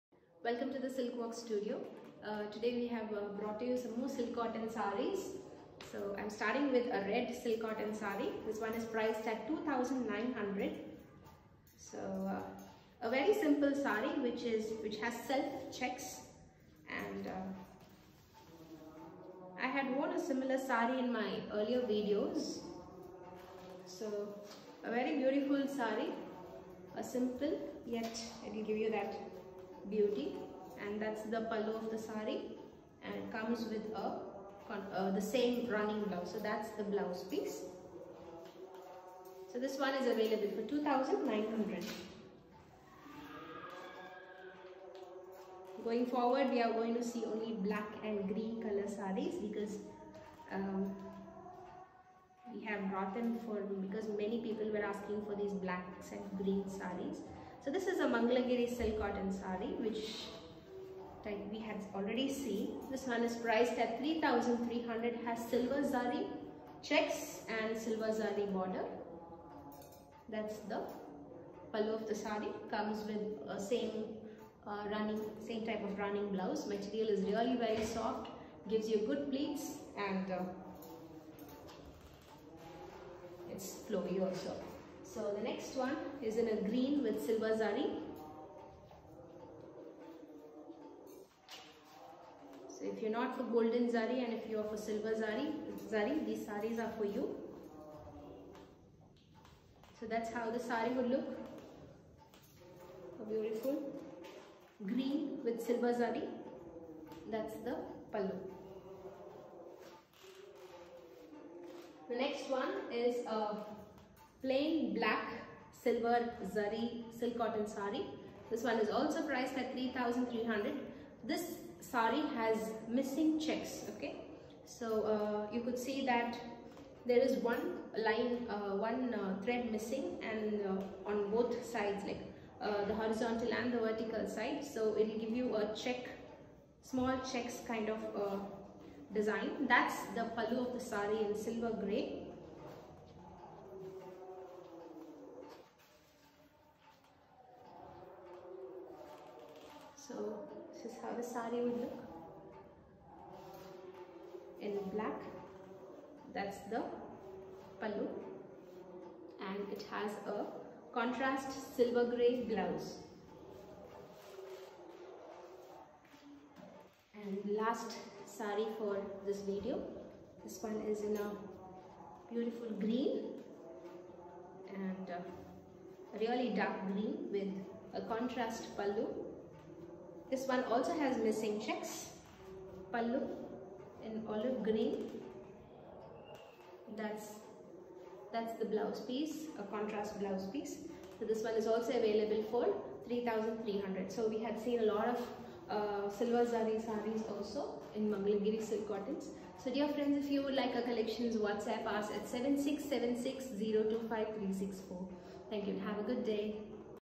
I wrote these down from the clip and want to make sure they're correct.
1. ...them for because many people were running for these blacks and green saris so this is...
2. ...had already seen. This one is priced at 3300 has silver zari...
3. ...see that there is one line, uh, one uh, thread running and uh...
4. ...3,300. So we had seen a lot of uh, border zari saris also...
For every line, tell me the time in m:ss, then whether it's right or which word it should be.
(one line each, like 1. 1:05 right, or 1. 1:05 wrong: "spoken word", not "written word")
1. 0:53 wrong: "asking", not "running"
2. 1:01 right
3. 2:05 wrong: "missing", not "running"
4. 3:13 wrong: "silver", not "border".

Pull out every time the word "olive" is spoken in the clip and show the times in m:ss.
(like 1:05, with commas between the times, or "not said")
3:04.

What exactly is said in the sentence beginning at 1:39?
So that's how the sari would look.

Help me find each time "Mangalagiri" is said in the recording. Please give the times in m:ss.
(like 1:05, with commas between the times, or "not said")
0:58, 3:18.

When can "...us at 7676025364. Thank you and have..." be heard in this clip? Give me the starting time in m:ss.
3:21.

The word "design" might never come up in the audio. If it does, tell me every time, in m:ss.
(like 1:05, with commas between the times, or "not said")
2:19.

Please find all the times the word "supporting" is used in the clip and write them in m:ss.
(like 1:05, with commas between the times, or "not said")
not said.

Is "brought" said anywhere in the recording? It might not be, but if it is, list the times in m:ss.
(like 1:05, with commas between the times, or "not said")
0:03, 0:52.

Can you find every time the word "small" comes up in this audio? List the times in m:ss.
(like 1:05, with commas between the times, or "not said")
2:16.